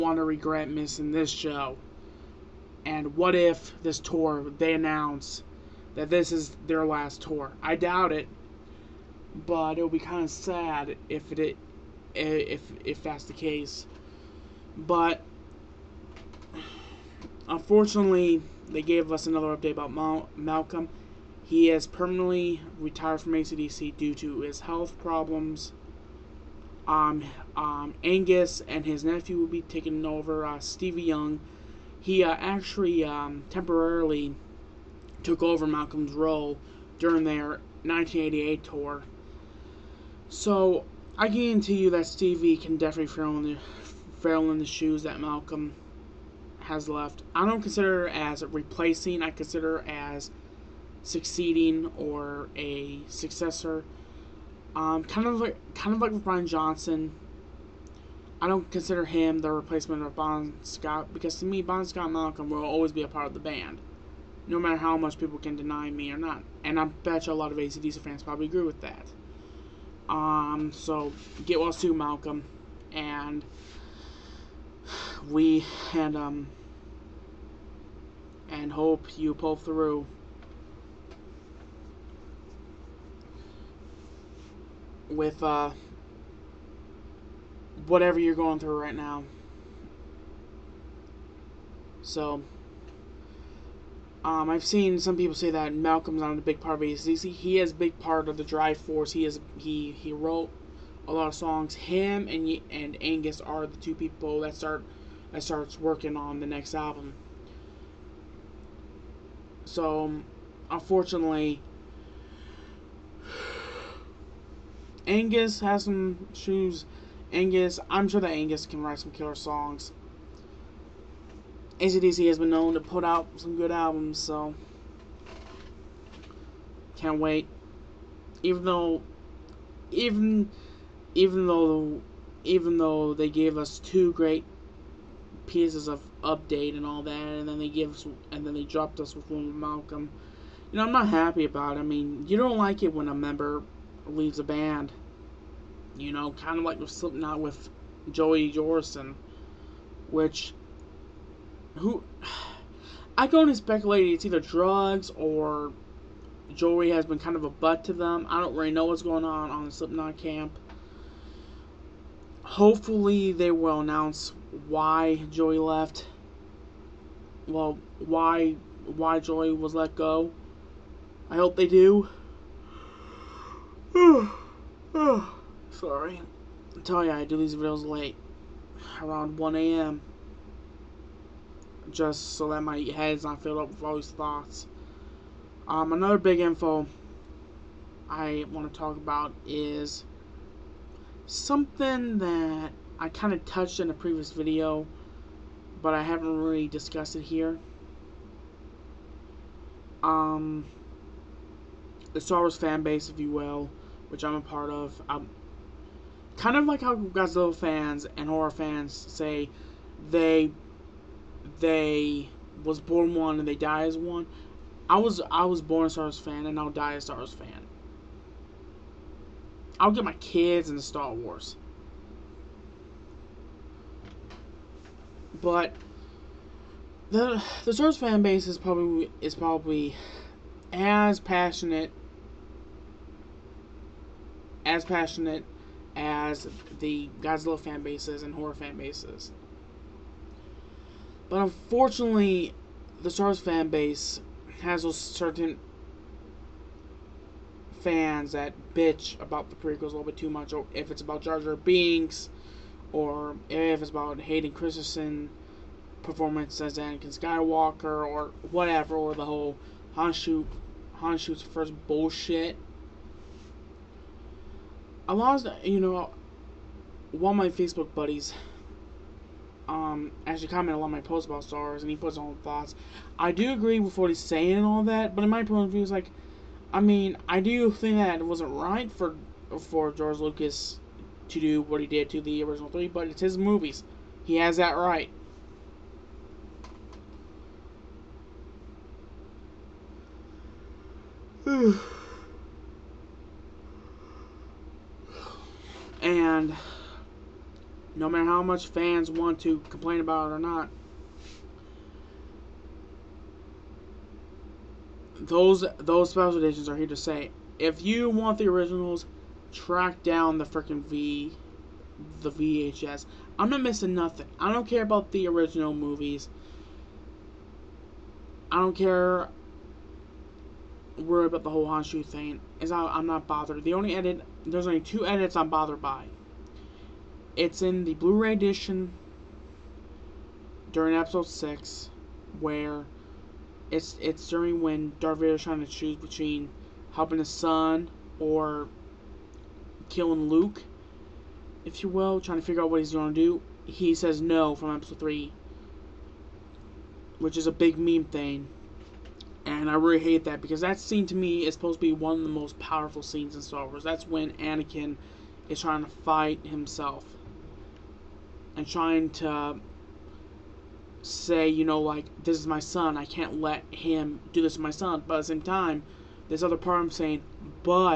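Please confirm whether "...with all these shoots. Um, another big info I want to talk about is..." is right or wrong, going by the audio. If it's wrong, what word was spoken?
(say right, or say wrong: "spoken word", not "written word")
wrong: "thoughts", not "shoots".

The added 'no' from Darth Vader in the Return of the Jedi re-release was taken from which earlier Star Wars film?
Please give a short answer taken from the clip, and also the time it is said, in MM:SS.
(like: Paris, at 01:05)
Episode 3, at 05:44.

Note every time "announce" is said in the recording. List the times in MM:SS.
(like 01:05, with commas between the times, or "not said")
00:04, 02:43.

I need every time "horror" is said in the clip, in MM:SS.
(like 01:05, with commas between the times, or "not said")
03:28, 03:58.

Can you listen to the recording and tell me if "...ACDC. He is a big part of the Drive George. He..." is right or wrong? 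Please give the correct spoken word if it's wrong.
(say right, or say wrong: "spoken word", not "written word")
wrong: "Force", not "George".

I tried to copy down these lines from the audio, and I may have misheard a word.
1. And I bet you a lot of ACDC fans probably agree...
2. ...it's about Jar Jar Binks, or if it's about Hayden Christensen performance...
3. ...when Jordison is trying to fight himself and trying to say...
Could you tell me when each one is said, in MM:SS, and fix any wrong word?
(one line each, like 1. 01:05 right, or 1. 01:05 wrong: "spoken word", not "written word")
1. 01:06 right
2. 04:10 right
3. 05:54 wrong: "Anakin", not "Jordison".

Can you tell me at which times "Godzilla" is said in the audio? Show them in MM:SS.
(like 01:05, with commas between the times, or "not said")
03:26, 03:57.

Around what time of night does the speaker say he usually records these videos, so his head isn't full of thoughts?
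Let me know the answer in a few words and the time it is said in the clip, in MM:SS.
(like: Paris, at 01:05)
1 a.m., at 02:59.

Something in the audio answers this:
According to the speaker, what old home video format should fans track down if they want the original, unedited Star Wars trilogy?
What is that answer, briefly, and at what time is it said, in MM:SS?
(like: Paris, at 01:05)
VHS, at 05:12.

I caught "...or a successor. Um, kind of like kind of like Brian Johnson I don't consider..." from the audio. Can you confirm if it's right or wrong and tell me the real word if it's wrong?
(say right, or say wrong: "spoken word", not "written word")
right.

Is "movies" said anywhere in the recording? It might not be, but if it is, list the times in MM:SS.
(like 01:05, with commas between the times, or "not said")
04:43, 05:15.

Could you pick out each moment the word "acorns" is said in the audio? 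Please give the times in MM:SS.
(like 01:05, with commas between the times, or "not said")
not said.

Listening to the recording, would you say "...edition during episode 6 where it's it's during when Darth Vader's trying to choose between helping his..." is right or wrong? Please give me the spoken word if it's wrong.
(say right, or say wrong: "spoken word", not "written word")
right.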